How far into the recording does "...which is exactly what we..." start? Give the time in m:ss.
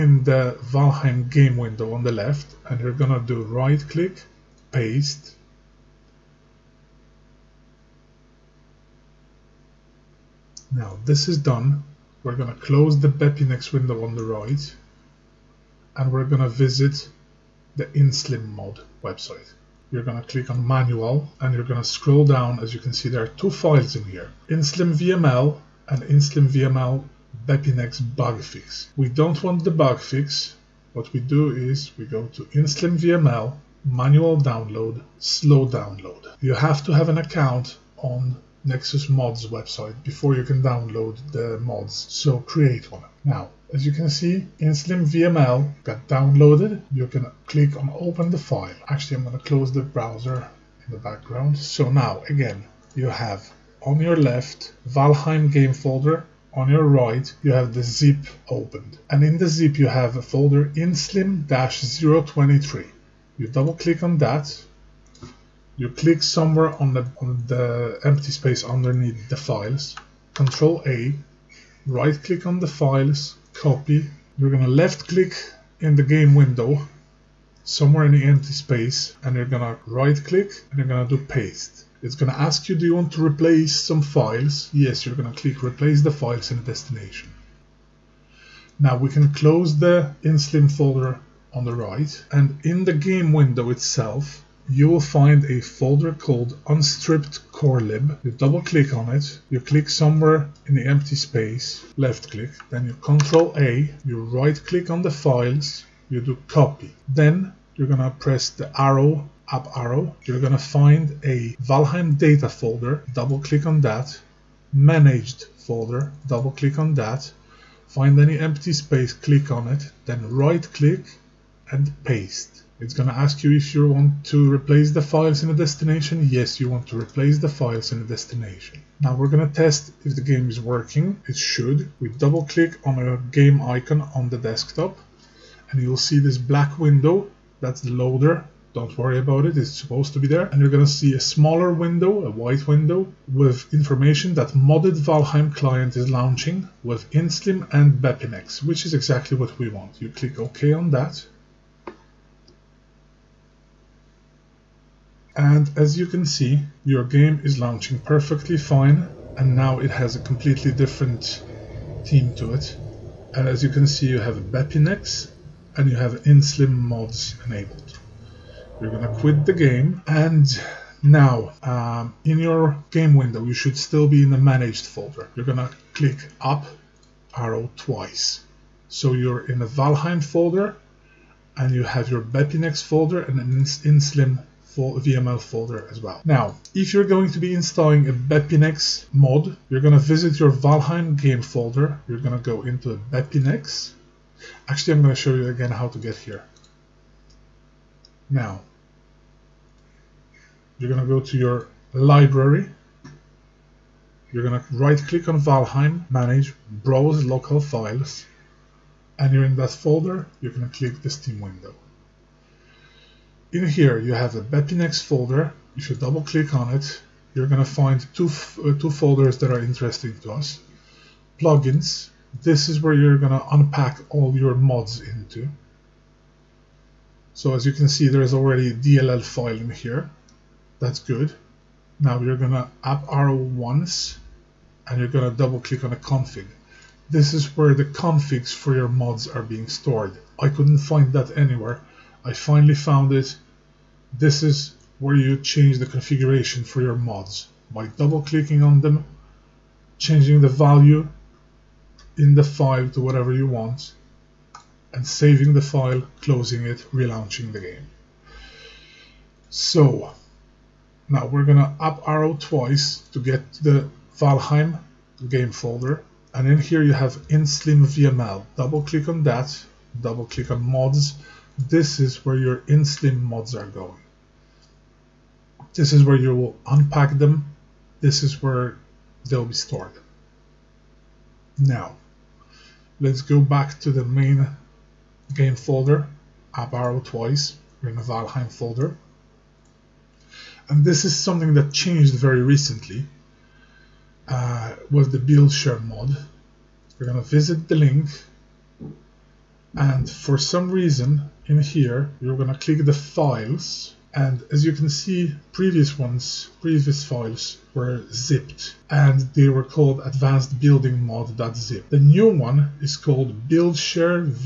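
2:28.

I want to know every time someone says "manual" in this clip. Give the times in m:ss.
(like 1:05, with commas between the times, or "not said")
0:20, 0:33.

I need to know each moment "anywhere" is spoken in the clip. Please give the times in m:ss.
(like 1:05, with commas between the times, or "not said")
4:01.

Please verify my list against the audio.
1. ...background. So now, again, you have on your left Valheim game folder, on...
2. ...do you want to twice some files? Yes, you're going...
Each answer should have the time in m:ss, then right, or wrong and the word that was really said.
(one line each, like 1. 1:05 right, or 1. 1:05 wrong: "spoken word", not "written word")
1. 0:50 right
2. 1:22 wrong: "replace", not "twice".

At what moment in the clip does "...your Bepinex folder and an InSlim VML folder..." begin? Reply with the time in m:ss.
3:02.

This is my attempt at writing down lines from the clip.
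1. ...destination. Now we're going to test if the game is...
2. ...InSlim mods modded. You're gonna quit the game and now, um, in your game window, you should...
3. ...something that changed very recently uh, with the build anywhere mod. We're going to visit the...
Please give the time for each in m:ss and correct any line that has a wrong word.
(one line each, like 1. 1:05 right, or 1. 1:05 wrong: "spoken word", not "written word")
1. 2:08 right
2. 2:46 wrong: "enabled", not "modded"
3. 4:51 wrong: "share", not "anywhere".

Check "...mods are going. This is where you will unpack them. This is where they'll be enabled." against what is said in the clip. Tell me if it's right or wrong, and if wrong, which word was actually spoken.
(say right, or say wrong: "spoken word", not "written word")
wrong: "stored", not "enabled".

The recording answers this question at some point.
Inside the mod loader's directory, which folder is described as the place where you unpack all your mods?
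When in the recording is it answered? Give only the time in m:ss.
3:41.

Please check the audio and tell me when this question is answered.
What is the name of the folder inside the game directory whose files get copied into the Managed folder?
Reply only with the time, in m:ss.
1:36.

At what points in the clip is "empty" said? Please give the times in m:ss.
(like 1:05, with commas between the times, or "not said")
1:08, 1:18, 1:40, 1:58.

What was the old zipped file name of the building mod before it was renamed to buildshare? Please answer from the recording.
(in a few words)
advanced building mod.zip.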